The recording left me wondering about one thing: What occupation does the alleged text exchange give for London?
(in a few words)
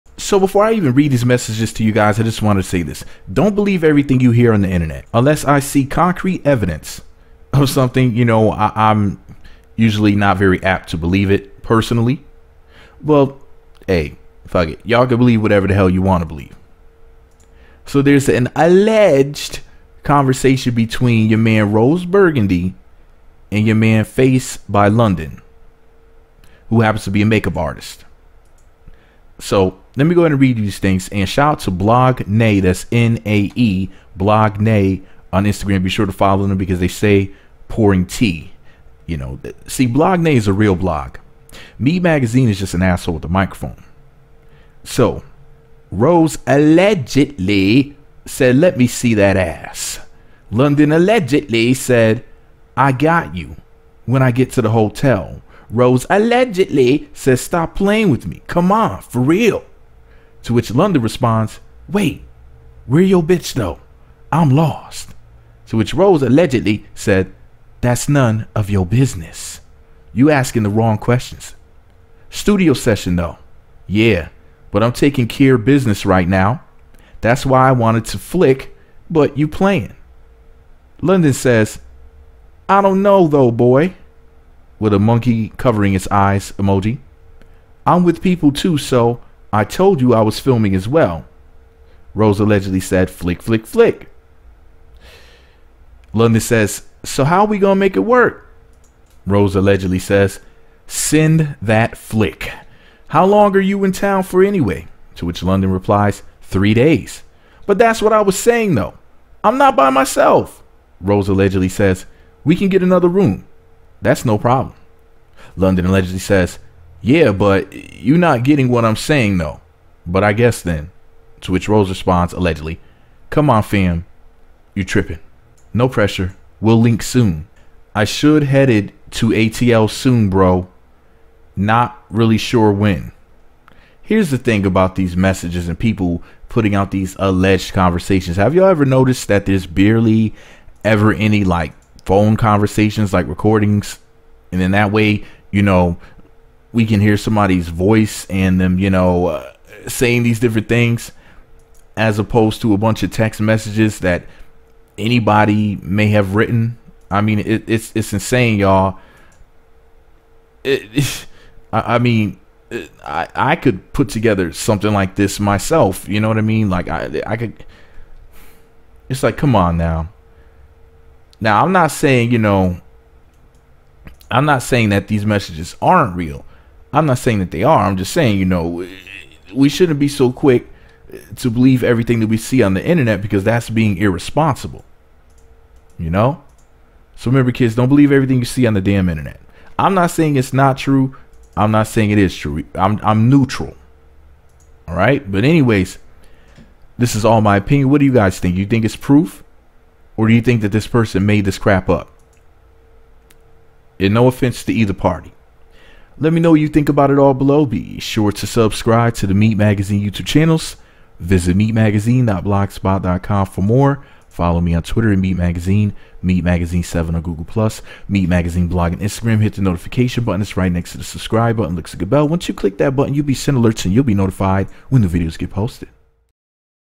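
Makeup artist.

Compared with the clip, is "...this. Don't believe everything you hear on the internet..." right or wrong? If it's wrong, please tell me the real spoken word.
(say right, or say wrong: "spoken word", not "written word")
right.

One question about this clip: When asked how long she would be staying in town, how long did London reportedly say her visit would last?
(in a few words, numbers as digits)
3 days.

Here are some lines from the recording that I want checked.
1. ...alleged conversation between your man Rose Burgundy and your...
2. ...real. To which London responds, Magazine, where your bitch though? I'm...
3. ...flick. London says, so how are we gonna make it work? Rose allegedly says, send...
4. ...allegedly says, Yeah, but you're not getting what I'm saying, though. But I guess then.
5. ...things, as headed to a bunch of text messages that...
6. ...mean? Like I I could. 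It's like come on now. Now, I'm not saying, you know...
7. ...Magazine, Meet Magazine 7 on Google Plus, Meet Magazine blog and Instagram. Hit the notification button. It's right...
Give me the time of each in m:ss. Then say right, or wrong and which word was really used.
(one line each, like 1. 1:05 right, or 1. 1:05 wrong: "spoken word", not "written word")
1. 0:18 right
2. 0:59 wrong: "Wait", not "Magazine"
3. 1:33 right
4. 1:55 right
5. 2:30 wrong: "opposed", not "headed"
6. 2:46 right
7. 3:35 right.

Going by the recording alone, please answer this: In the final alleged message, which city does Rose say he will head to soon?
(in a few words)
ATL.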